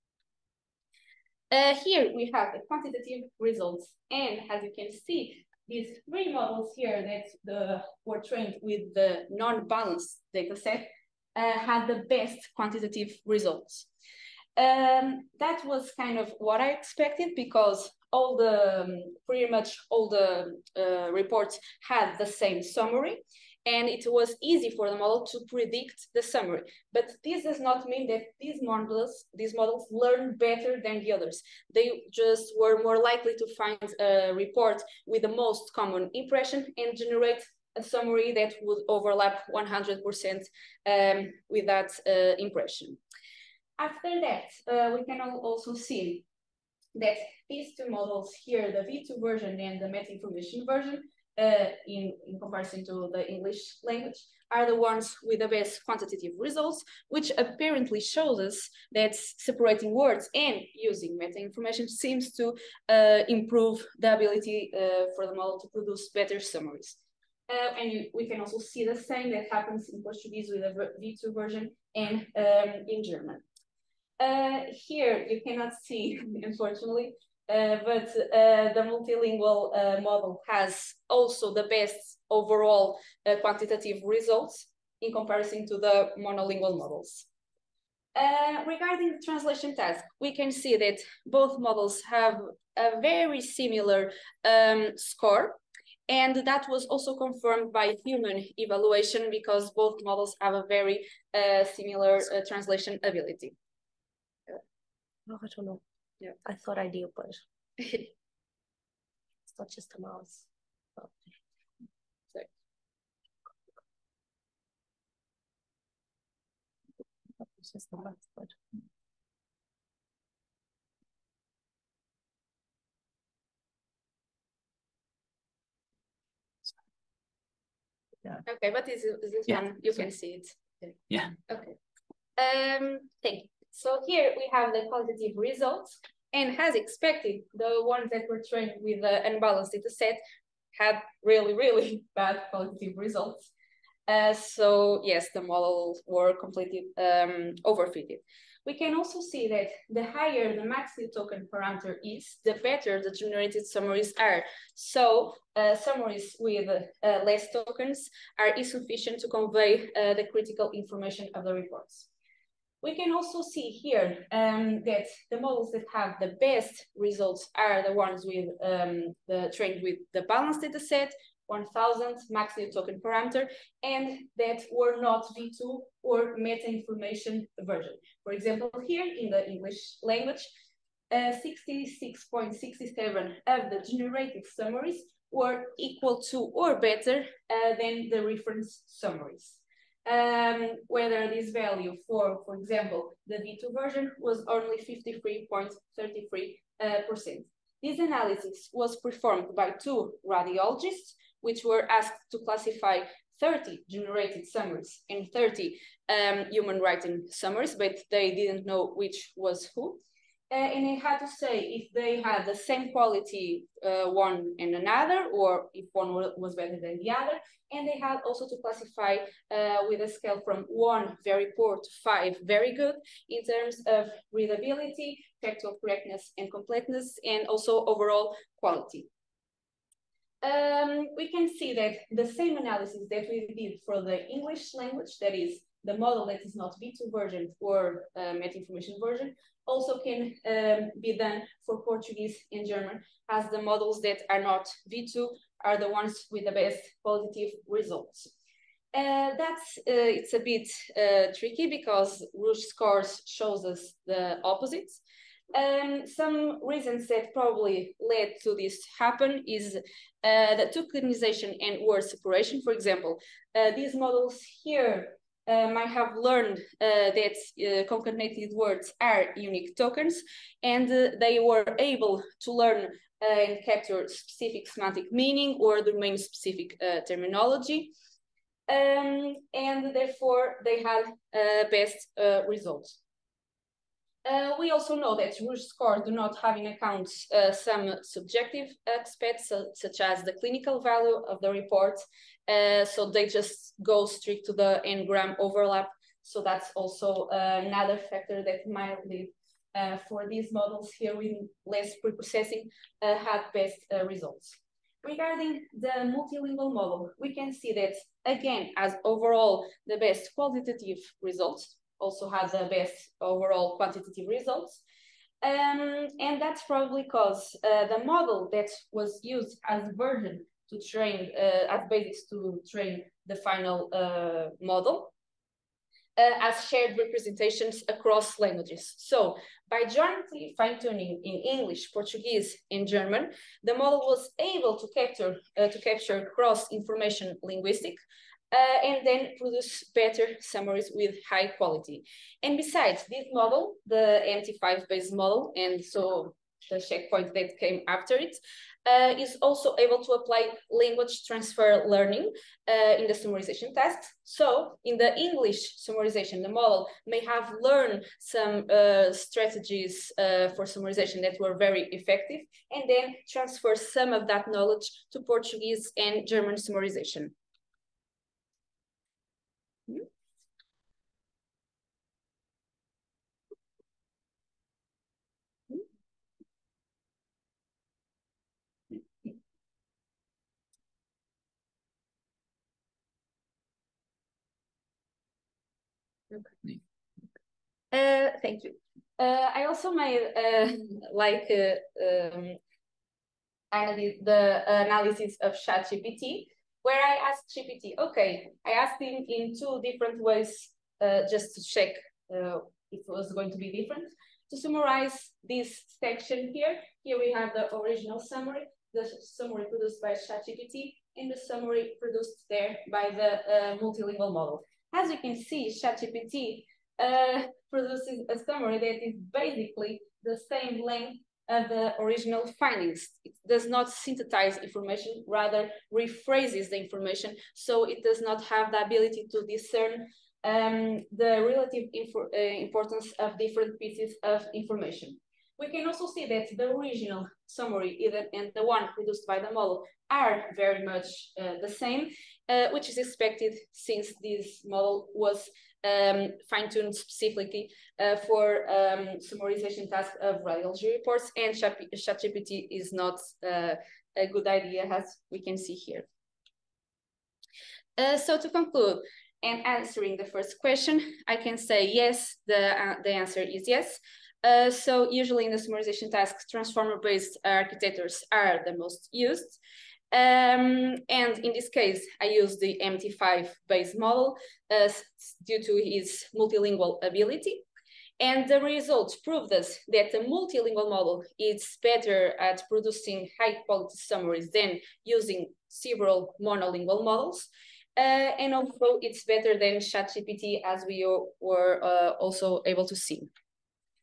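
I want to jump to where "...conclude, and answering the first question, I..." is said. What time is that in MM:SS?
07:38.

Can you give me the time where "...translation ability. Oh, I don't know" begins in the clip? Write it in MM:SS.
01:42.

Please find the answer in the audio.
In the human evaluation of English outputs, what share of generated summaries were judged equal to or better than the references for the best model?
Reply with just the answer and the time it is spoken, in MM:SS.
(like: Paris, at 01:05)
66.67, at 03:01.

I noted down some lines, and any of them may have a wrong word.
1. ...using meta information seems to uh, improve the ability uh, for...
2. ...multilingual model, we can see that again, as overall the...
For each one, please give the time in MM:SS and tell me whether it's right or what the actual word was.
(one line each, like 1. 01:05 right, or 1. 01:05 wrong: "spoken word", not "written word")
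1. 01:00 right
2. 05:06 right.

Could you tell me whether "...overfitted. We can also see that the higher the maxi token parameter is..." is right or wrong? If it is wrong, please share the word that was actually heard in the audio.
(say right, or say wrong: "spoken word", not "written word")
right.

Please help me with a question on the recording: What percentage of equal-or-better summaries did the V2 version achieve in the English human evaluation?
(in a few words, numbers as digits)
53.33%.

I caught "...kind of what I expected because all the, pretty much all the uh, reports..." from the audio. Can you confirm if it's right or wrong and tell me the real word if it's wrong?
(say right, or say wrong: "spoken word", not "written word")
right.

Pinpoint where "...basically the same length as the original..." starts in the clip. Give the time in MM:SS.
06:59.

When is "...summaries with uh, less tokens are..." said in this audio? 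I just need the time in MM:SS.
02:35.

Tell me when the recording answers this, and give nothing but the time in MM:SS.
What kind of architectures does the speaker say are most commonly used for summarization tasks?
07:46.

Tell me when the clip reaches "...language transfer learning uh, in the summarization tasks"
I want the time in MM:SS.
05:50.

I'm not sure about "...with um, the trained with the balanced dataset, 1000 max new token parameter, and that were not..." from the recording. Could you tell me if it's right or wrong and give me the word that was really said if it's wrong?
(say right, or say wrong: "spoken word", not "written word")
right.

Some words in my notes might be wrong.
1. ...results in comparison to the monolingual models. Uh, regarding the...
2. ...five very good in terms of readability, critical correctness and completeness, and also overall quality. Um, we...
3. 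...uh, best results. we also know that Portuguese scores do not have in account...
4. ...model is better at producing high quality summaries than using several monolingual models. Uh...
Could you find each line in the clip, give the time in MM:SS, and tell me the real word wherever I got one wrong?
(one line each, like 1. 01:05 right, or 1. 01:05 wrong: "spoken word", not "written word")
1. 01:24 right
2. 03:42 wrong: "factual", not "critical"
3. 04:41 wrong: "Rouge", not "Portuguese"
4. 08:00 right.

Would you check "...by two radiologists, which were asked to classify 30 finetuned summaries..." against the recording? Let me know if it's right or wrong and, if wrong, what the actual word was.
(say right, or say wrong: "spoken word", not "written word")
wrong: "generated", not "finetuned".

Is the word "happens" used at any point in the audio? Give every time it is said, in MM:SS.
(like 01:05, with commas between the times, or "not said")
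01:09, 04:18.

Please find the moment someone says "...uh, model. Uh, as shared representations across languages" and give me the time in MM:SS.
05:23.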